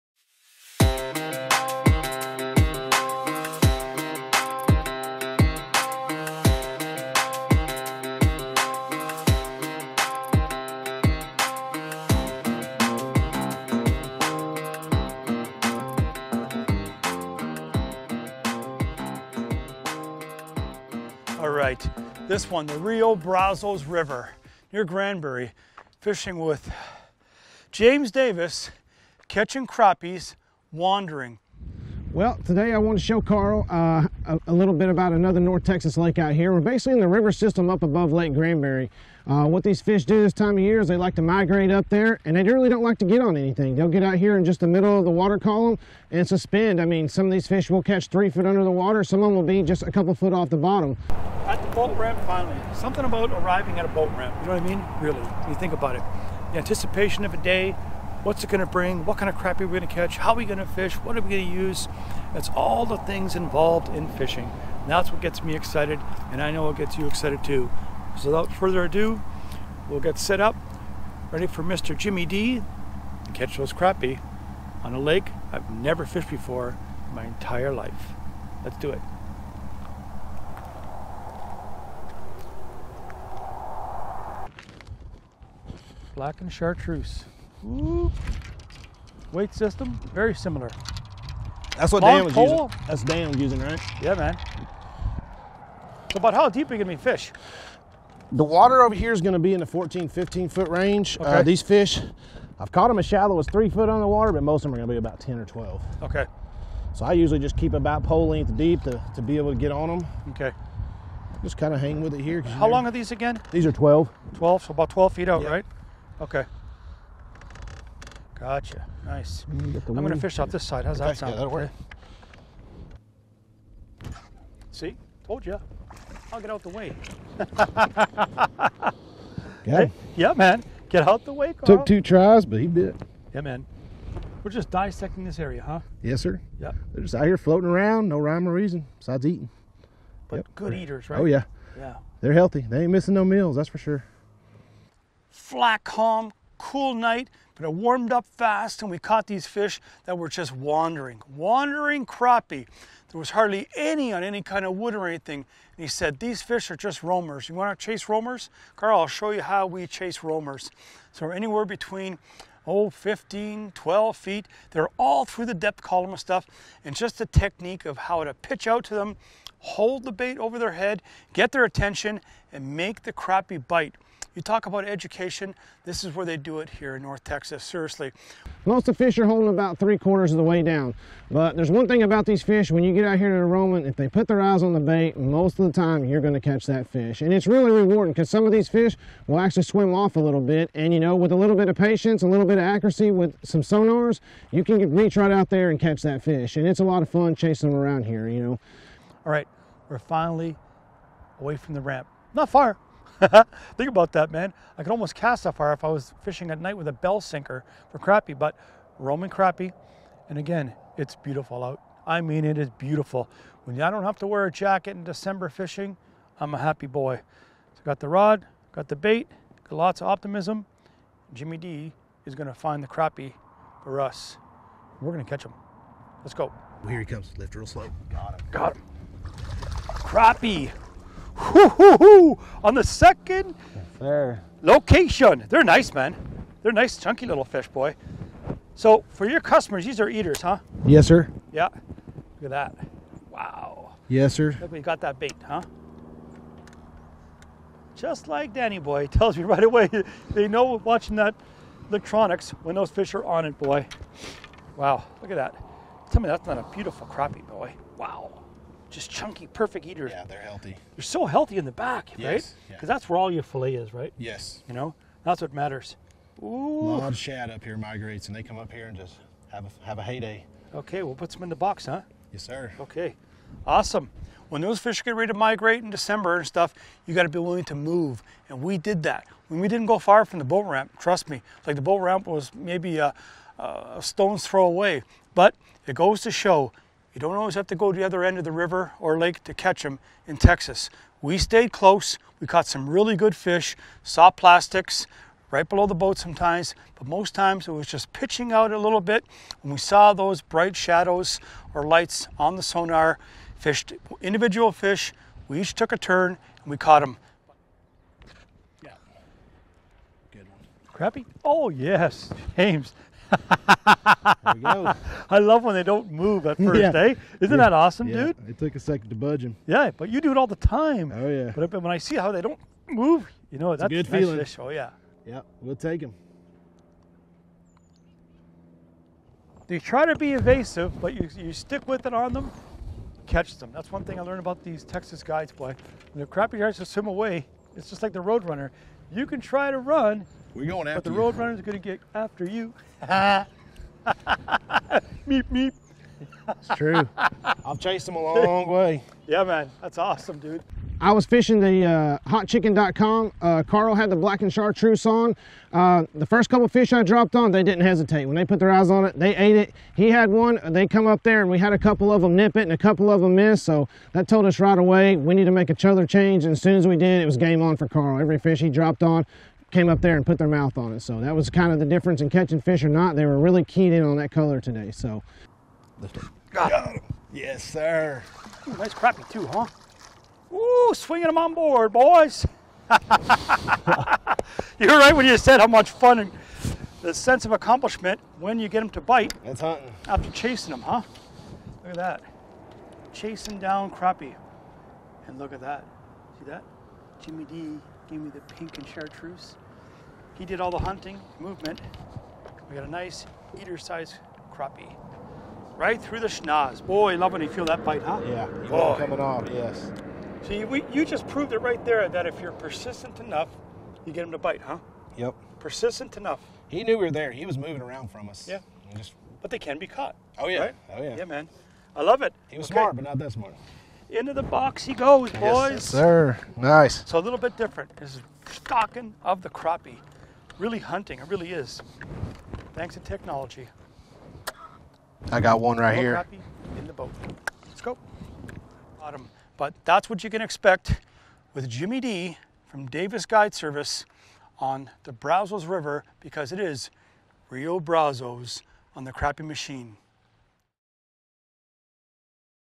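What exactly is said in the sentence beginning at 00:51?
At the boat ramp, finally, something about arriving at a boat ramp.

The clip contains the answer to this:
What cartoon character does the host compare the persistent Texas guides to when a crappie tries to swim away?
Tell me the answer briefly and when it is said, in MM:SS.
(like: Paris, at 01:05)
The roadrunner, at 05:38.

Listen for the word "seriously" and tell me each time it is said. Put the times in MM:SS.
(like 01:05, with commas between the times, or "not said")
02:57.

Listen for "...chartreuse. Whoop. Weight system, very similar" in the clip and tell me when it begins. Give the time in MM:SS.
01:26.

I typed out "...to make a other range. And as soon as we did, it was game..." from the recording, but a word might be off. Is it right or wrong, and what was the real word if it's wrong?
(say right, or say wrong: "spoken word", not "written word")
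wrong: "change", not "range".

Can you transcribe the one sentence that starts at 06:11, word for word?
So that was kind of the difference in catching fish or not.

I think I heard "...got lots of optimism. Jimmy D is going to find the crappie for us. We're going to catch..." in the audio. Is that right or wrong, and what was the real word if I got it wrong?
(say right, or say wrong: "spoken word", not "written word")
right.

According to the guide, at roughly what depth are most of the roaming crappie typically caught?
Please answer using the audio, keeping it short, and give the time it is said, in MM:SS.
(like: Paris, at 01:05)
10 or 12 feet, at 01:44.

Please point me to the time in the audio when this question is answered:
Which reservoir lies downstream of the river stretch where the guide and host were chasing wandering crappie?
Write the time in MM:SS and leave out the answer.
00:38.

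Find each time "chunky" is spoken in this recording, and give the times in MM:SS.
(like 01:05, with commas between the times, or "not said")
03:56, 04:19.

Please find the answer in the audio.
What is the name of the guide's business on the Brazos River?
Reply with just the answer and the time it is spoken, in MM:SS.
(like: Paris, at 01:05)
Davis Guide Service, at 07:22.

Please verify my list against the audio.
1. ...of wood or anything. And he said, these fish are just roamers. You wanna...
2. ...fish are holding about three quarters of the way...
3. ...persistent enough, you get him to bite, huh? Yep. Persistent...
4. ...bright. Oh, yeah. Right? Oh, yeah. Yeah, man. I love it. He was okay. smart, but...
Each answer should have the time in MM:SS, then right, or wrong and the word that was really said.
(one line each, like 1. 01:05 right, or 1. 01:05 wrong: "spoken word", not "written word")
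1. 02:34 right
2. 02:59 right
3. 06:52 right
4. 06:59 wrong: "caught", not "bright".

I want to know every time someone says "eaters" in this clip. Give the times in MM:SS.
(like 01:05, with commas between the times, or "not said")
02:20, 04:00, 04:19, 06:43.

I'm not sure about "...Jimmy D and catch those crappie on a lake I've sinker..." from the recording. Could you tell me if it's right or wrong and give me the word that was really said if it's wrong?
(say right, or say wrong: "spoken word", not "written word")
wrong: "never", not "sinker".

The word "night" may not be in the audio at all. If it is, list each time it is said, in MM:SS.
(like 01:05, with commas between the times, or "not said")
02:26, 03:26.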